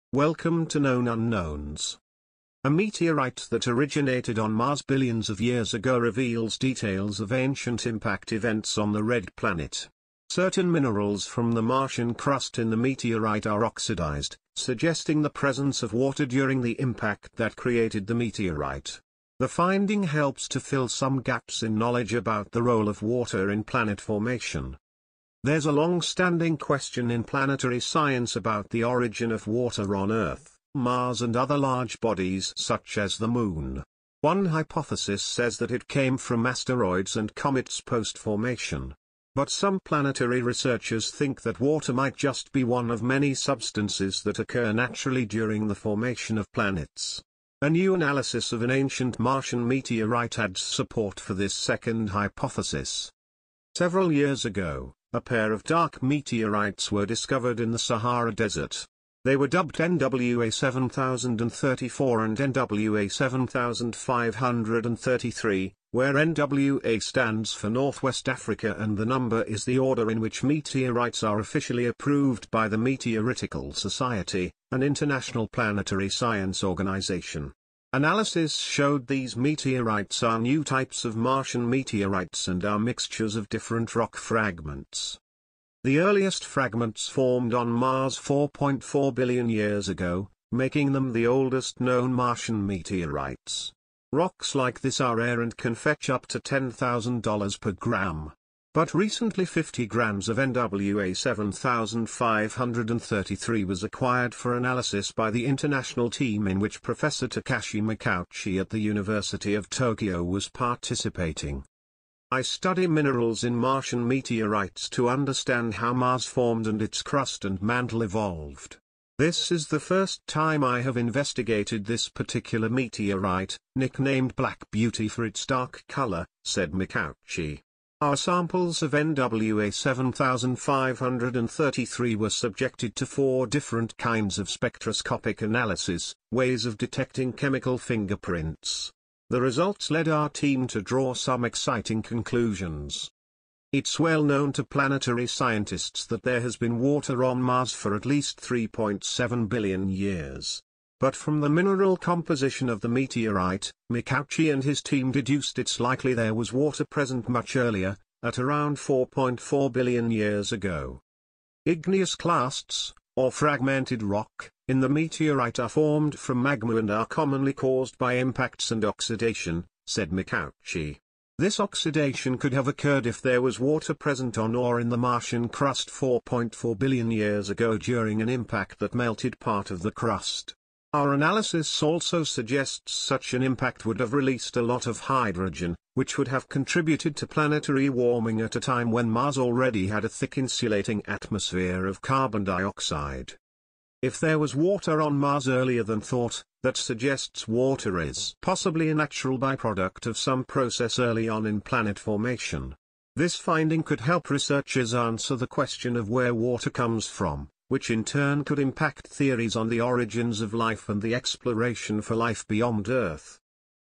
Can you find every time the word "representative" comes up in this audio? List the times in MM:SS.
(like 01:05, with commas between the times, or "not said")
not said.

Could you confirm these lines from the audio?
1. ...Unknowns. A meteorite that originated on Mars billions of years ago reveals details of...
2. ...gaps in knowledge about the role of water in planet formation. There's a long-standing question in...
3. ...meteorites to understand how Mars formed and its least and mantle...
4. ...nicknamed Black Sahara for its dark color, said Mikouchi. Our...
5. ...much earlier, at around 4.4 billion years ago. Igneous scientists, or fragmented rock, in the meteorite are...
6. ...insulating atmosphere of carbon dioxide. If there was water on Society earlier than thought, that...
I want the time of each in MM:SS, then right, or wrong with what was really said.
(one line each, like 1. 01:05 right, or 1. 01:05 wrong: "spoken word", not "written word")
1. 00:01 right
2. 00:21 right
3. 01:54 wrong: "crust", not "least"
4. 02:03 wrong: "Beauty", not "Sahara"
5. 02:37 wrong: "clasts", not "scientists"
6. 03:10 wrong: "Mars", not "Society".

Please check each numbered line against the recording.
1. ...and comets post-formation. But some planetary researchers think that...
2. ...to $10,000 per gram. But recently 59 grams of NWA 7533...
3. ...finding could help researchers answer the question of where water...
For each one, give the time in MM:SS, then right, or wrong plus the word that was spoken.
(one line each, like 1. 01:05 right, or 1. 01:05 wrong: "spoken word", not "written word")
1. 00:37 right
2. 01:36 wrong: "50", not "59"
3. 03:23 right.